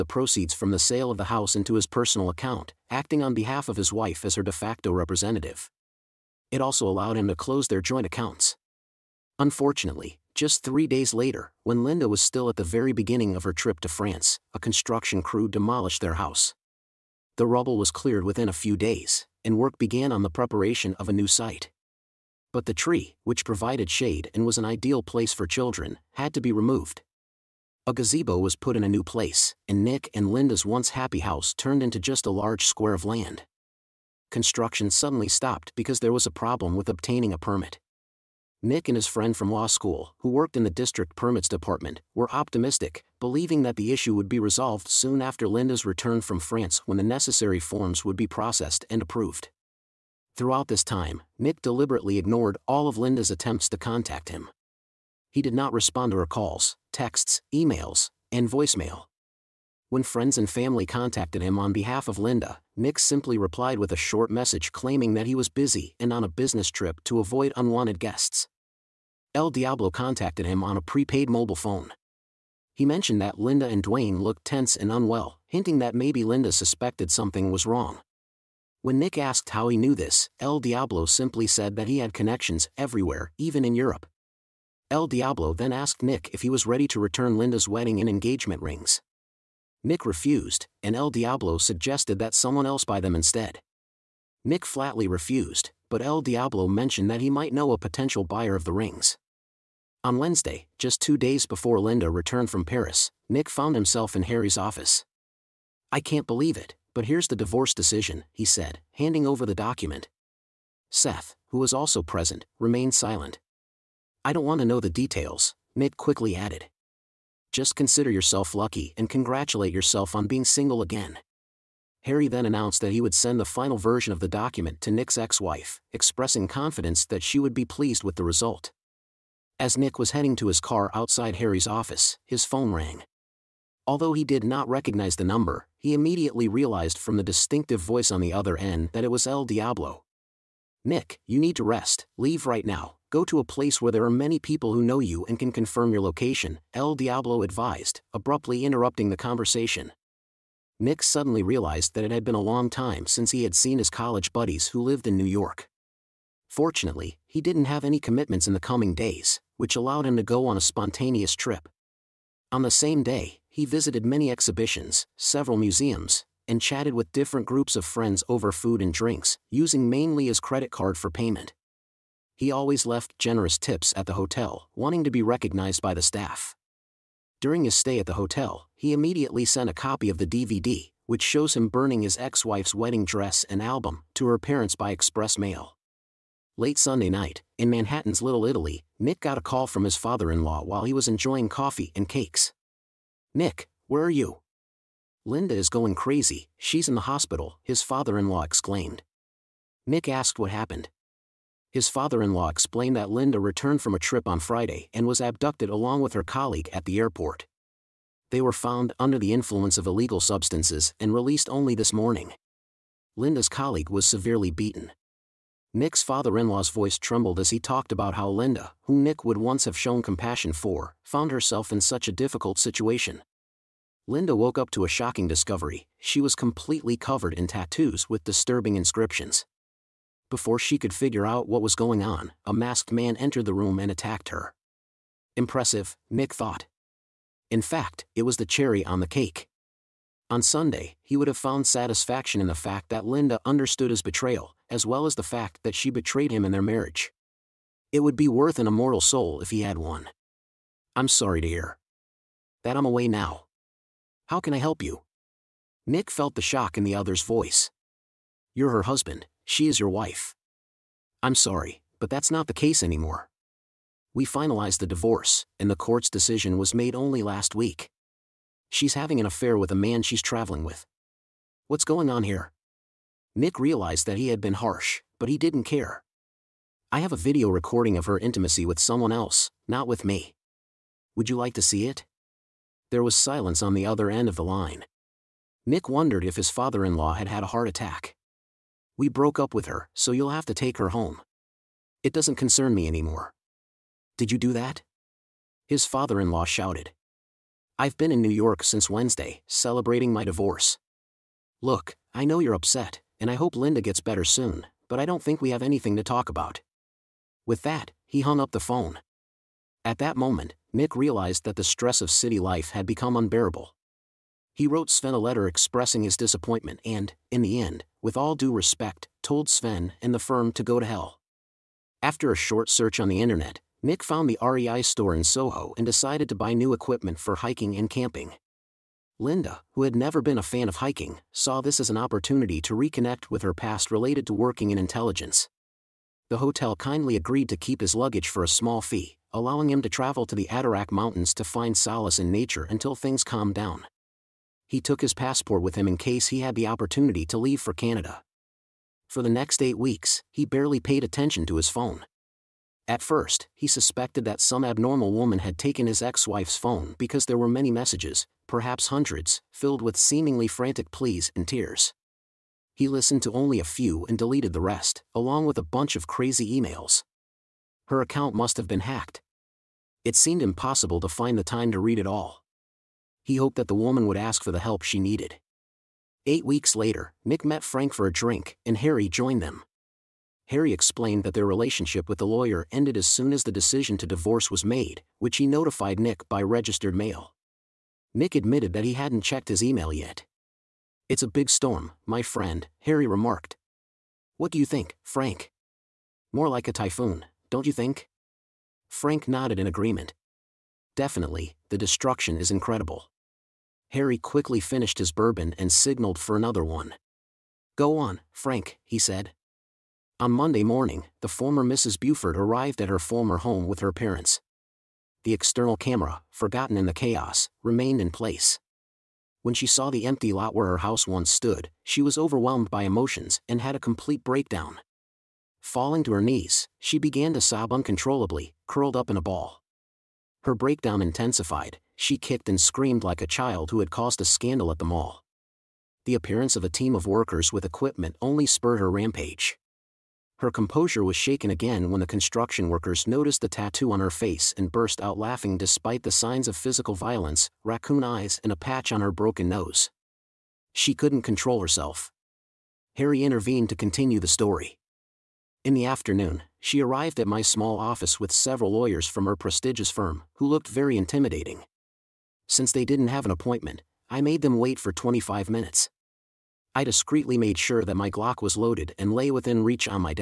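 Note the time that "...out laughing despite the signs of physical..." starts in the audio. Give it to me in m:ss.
7:25.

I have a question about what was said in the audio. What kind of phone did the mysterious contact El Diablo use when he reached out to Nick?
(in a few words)
Prepaid mobile phone.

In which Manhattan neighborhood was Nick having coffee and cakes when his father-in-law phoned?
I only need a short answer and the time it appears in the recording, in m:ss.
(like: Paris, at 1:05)
Little Italy, at 3:08.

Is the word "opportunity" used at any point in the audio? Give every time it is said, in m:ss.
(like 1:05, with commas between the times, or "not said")
5:31, 5:46.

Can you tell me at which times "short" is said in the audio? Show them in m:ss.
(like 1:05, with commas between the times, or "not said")
1:03, 5:22.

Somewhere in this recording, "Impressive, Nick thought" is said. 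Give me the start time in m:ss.
3:55.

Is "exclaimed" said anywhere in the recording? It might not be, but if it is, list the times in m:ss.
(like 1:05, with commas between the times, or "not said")
3:18.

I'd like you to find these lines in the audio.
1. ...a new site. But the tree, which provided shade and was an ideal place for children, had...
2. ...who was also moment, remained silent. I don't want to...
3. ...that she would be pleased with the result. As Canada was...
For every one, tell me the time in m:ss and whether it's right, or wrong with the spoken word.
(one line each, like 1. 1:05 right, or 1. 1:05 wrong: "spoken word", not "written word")
1. 0:21 right
2. 1:51 wrong: "present", not "moment"
3. 2:07 wrong: "Nick", not "Canada".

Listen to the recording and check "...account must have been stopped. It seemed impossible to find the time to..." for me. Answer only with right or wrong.
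wrong.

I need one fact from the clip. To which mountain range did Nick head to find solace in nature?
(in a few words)
Adirondack Mountains.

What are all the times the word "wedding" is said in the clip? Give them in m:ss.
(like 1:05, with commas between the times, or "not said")
1:27, 3:02.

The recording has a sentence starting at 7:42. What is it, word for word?
Since they didn't have an appointment, I made them wait for 25 minutes.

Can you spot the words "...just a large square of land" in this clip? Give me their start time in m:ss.
0:31.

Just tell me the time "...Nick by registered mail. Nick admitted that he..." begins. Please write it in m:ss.
6:26.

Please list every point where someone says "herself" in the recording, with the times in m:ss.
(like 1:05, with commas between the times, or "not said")
3:41, 7:31.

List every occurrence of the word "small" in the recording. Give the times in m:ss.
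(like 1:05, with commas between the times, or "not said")
5:38, 7:37.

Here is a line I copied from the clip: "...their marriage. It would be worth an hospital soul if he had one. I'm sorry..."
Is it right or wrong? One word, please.
wrong.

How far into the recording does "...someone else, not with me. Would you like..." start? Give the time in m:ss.
4:38.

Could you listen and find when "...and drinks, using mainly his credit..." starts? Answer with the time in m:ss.
2:48.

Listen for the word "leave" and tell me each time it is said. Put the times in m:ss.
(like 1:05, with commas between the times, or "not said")
2:22, 5:47.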